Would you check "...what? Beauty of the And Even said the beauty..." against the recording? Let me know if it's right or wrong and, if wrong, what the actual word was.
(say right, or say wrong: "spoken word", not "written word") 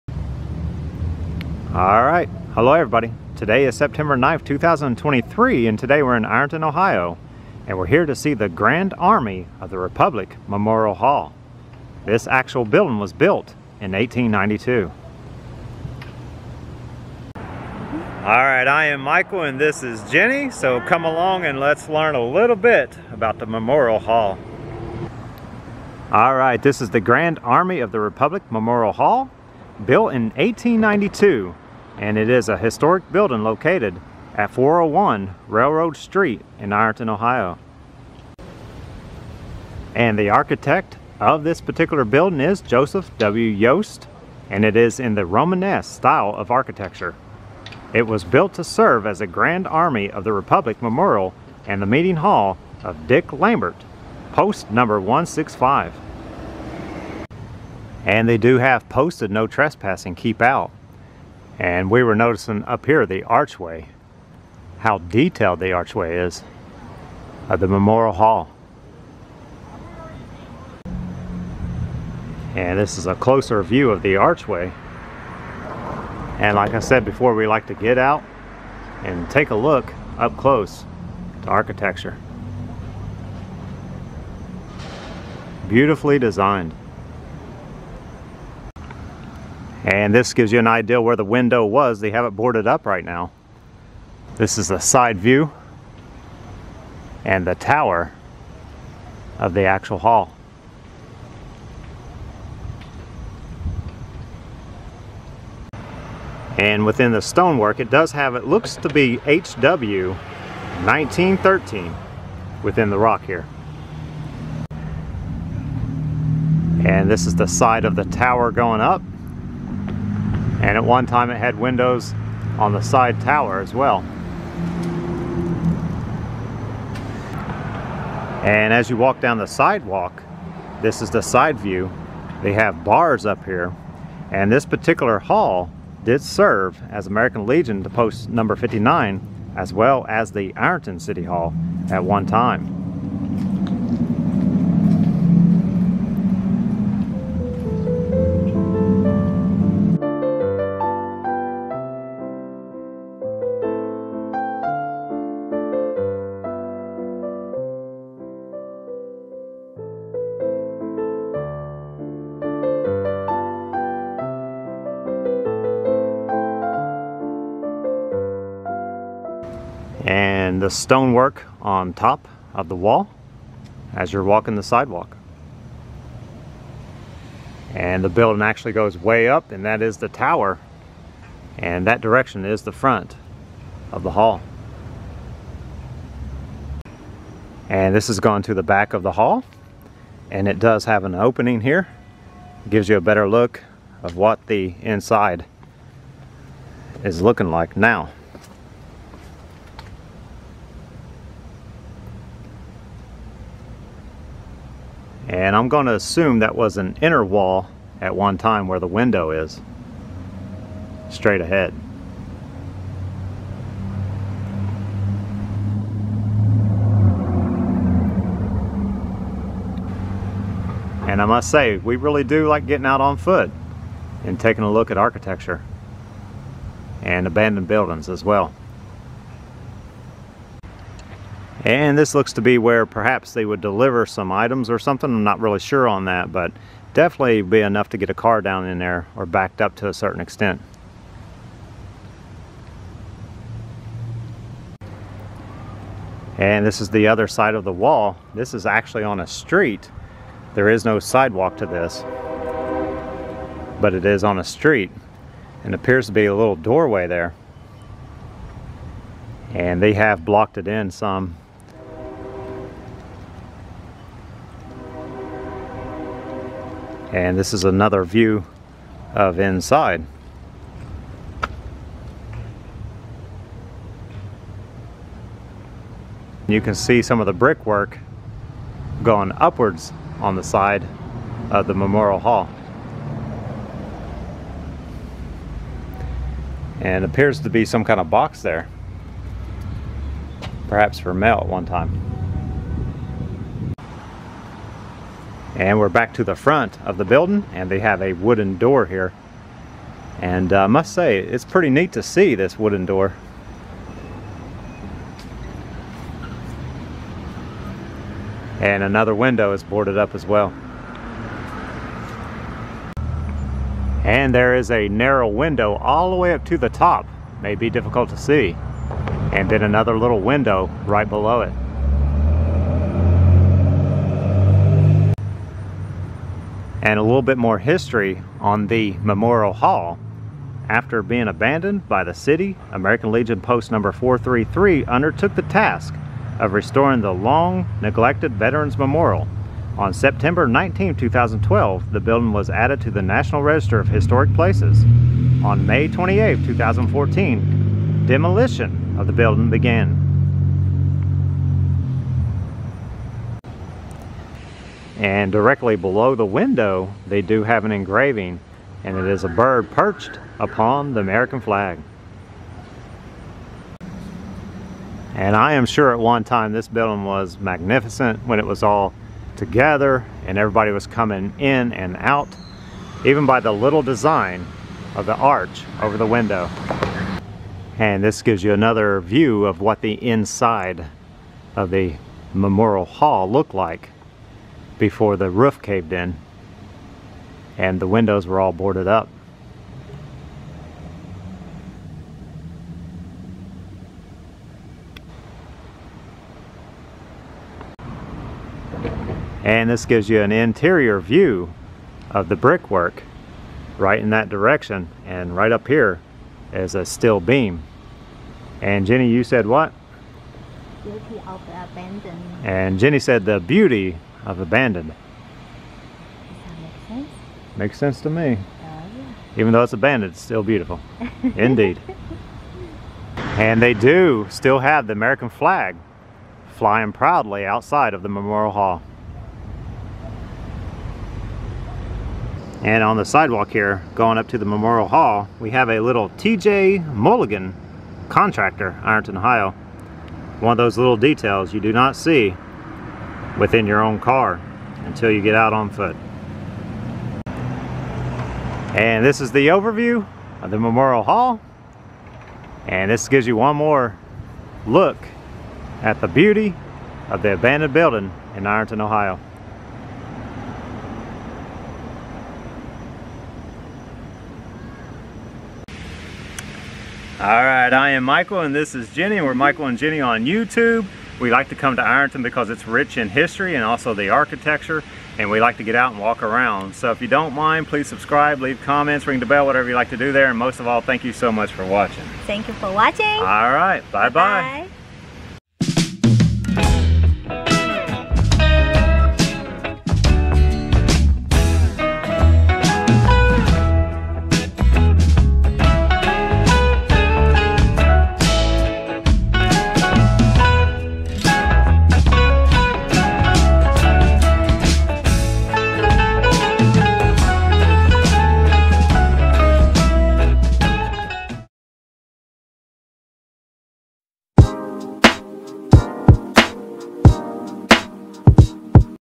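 wrong: "Jenny", not "Even".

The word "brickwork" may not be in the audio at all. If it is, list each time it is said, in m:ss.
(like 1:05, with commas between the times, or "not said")
4:37, 6:42.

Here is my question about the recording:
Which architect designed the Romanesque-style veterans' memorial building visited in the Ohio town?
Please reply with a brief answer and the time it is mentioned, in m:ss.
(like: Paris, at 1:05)
Joseph W. Yost, at 0:42.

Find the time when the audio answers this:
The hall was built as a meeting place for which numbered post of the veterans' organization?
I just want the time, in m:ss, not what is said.
0:53.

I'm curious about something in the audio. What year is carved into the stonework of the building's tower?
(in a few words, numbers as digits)
1913.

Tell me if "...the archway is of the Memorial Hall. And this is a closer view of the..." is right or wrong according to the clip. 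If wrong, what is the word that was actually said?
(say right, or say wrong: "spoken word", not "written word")
right.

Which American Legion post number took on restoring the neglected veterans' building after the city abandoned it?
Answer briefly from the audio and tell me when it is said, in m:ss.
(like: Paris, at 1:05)
433, at 5:33.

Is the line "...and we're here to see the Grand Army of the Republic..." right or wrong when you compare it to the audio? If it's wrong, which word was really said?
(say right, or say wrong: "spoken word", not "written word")
right.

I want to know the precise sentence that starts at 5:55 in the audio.
And directly below the window, they do have an engraving, and it is a bird perched upon the American flag.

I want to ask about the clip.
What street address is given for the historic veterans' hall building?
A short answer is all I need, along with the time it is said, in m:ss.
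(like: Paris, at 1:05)
401 Railroad Street, at 0:34.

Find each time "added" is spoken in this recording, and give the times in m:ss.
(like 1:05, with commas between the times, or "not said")
5:42.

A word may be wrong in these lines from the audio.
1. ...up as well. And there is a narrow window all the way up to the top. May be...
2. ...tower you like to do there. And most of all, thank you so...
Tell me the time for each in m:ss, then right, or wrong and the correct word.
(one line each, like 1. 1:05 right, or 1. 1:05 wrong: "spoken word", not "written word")
1. 5:09 right
2. 7:59 wrong: "whatever", not "tower".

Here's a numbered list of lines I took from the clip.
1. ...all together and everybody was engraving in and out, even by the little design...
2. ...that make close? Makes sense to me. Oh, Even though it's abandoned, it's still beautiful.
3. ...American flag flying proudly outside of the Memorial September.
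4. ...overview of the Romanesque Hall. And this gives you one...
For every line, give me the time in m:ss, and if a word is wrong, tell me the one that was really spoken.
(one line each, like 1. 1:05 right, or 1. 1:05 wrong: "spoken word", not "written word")
1. 6:08 wrong: "coming", not "engraving"
2. 6:56 wrong: "sense", not "close"
3. 7:04 wrong: "Hall", not "September"
4. 7:29 wrong: "Memorial", not "Romanesque".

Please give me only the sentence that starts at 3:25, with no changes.
And I'm going to assume that was an inner wall at one time where the window is.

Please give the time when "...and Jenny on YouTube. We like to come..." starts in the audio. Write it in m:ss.
7:49.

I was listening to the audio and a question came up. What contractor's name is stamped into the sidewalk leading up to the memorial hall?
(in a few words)
TJ Mulligan.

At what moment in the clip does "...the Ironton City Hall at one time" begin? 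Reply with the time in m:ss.
2:20.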